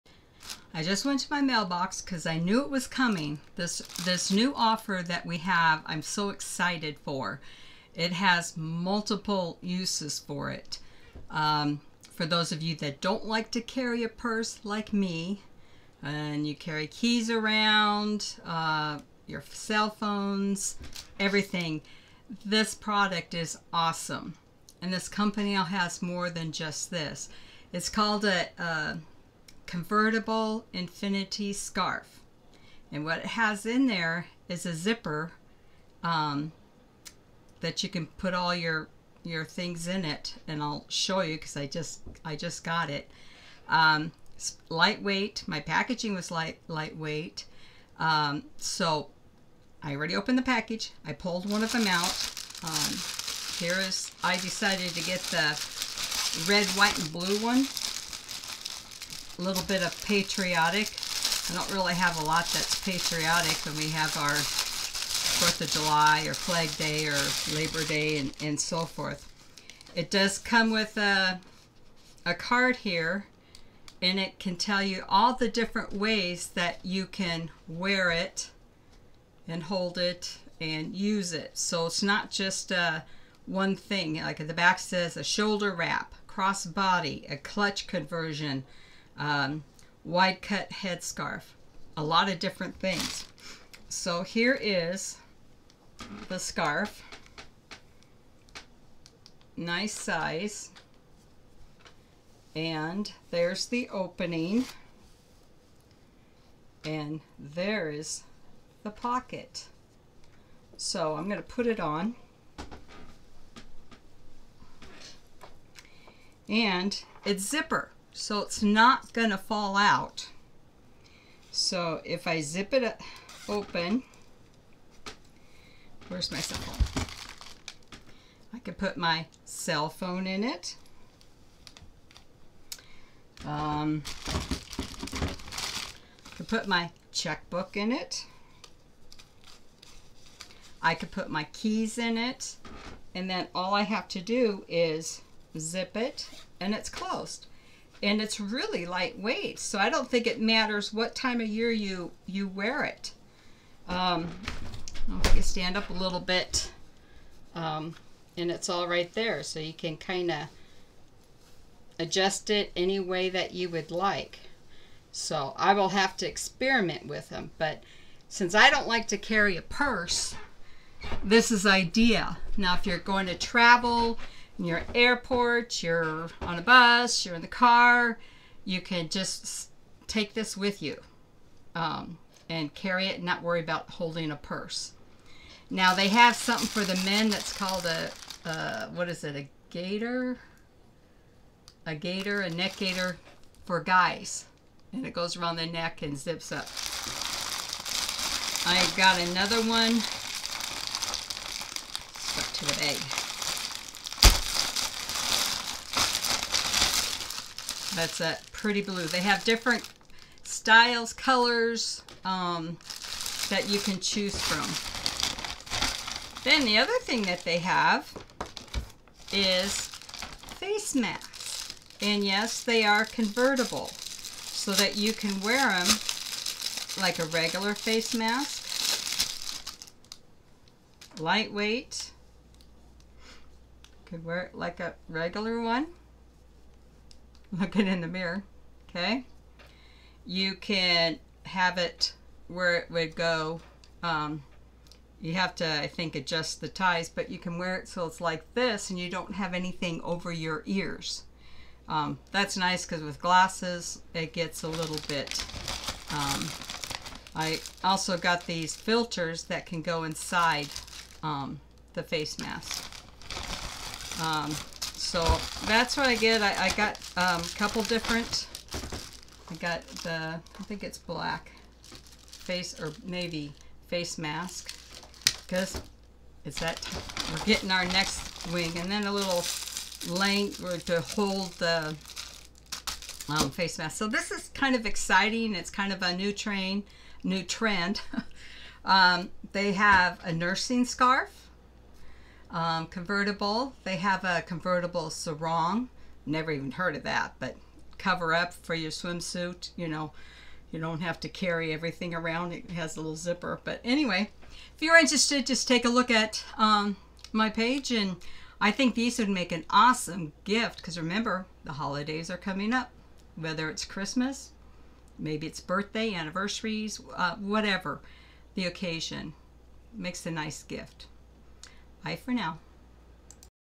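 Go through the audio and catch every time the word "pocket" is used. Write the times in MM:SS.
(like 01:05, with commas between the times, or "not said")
01:48.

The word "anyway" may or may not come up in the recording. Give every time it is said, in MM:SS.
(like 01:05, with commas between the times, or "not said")
05:03.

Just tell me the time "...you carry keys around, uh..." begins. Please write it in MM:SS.
00:16.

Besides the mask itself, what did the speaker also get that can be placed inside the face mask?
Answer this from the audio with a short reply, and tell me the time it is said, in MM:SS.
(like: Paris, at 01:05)
filters, at 04:18.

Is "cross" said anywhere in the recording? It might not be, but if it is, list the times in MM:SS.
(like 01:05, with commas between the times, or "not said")
01:26.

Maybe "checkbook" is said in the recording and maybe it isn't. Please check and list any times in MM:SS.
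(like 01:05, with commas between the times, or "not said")
02:17.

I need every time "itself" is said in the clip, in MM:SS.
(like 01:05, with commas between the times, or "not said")
not said.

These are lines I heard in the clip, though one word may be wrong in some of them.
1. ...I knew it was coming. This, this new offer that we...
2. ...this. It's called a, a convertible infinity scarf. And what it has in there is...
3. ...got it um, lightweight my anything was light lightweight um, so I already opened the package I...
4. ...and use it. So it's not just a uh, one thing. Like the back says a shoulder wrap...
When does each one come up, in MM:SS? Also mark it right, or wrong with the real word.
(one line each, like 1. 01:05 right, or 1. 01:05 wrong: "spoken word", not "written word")
1. 00:02 right
2. 00:26 right
3. 00:42 wrong: "packaging", not "anything"
4. 01:20 right.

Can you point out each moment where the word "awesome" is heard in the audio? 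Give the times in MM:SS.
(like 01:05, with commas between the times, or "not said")
00:23, 05:09.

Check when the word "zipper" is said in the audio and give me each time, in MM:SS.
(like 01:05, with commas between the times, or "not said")
00:34, 01:57, 05:03.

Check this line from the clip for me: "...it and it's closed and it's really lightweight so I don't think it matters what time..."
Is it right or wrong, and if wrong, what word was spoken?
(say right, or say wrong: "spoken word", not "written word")
right.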